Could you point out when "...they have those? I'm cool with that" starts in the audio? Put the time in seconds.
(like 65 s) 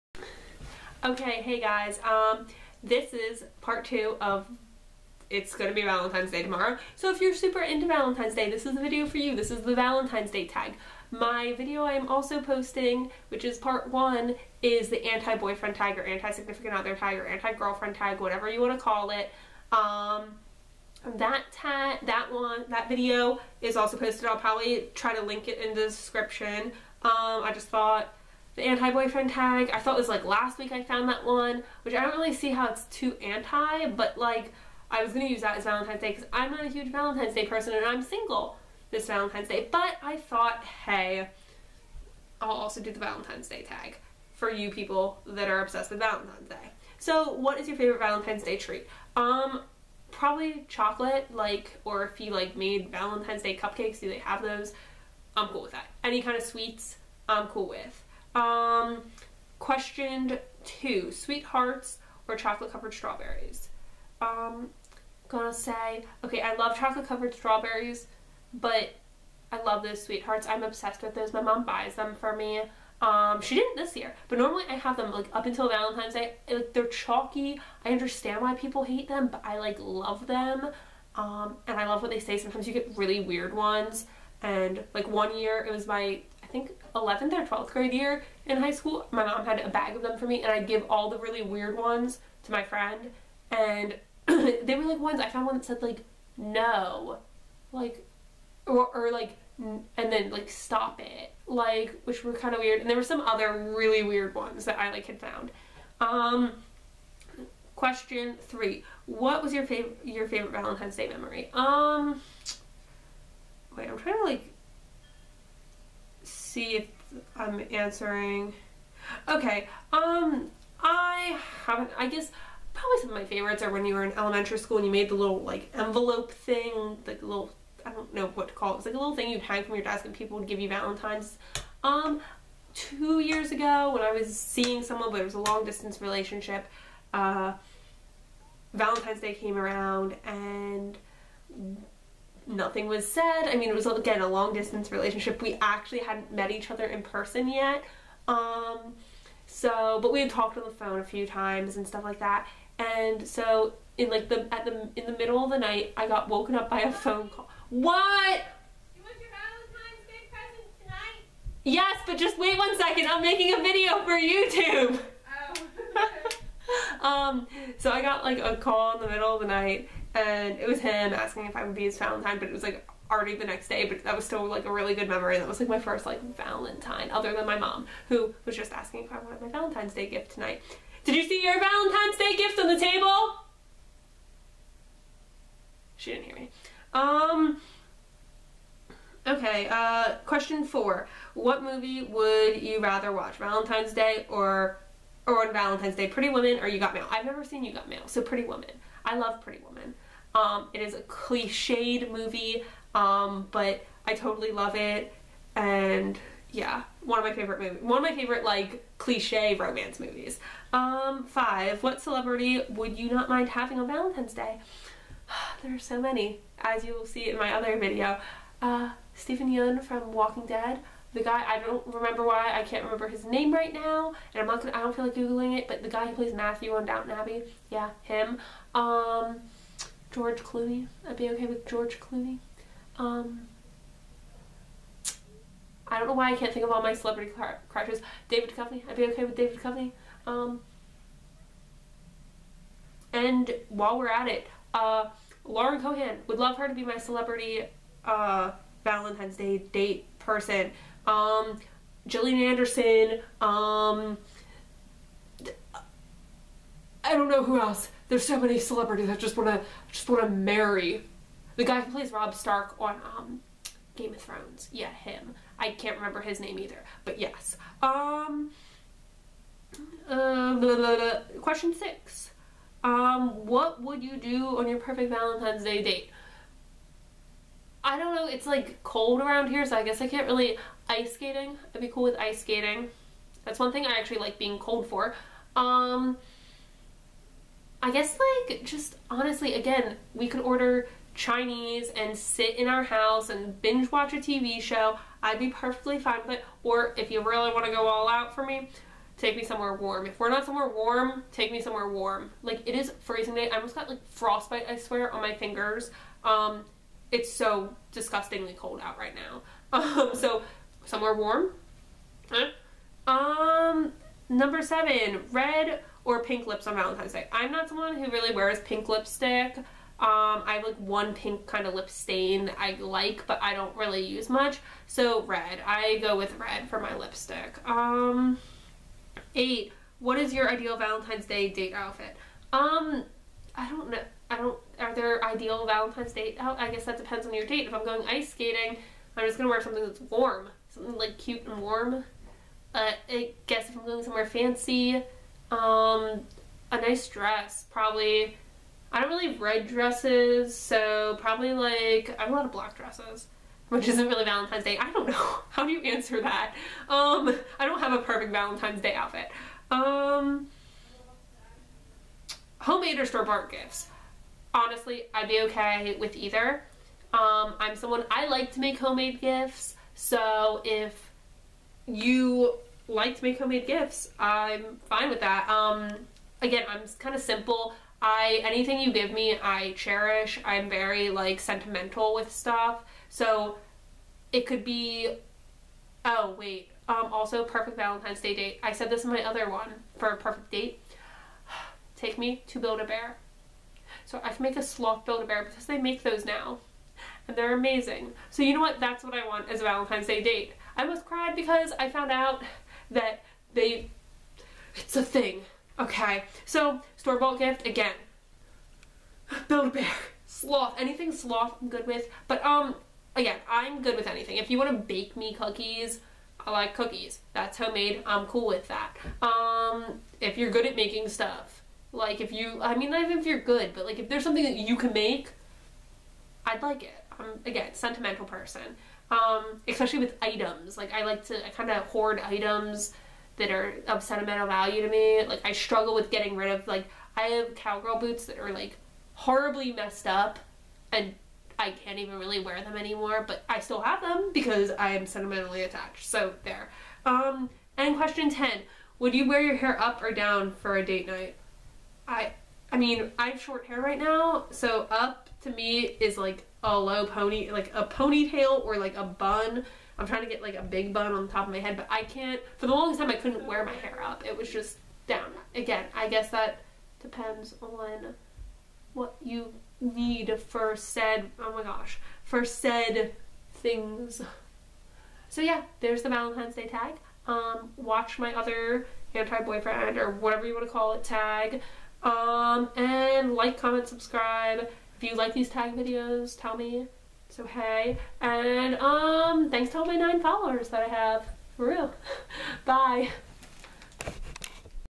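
54 s.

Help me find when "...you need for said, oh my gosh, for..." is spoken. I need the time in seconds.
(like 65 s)
469 s.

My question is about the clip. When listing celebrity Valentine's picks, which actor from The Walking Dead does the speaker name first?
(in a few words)
Steven Yeun.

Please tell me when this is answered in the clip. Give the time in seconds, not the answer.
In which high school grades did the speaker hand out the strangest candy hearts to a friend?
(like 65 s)
86 s.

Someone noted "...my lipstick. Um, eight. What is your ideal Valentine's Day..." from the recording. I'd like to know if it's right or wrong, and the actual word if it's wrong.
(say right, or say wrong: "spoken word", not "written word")
right.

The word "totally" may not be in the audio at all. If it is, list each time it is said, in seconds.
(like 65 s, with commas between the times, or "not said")
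204 s.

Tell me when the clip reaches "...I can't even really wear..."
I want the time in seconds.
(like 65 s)
441 s.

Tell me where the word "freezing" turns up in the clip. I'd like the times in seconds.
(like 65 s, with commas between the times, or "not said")
303 s.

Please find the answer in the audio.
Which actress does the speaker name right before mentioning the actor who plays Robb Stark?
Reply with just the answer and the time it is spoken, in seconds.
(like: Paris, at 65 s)
Gillian Anderson, at 252 s.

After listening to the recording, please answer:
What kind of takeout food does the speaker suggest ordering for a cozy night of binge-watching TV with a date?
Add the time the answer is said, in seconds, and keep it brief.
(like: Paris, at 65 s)
Chinese, at 291 s.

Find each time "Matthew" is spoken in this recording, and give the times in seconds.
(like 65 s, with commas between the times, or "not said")
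226 s.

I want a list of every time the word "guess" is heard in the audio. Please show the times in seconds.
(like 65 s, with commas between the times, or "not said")
122 s, 279 s, 287 s, 336 s, 343 s, 466 s.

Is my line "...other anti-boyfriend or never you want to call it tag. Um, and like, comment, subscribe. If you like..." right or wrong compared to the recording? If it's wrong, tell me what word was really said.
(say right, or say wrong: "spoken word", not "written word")
wrong: "whatever", not "never".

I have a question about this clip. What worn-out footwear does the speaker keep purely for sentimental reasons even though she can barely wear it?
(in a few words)
Cowgirl boots.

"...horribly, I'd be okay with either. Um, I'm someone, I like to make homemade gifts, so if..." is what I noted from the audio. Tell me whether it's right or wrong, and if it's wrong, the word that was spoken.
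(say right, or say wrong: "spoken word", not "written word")
wrong: "honestly", not "horribly".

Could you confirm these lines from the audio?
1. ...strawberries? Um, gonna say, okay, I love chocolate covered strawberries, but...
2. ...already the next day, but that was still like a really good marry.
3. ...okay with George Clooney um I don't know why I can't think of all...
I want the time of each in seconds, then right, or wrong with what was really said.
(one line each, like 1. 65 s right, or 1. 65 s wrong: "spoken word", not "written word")
1. 62 s right
2. 173 s wrong: "memory", not "marry"
3. 231 s right.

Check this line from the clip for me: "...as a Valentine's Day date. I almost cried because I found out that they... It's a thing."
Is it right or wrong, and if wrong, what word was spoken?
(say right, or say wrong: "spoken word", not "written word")
right.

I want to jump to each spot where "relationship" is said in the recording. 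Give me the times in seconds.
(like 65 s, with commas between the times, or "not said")
136 s, 144 s.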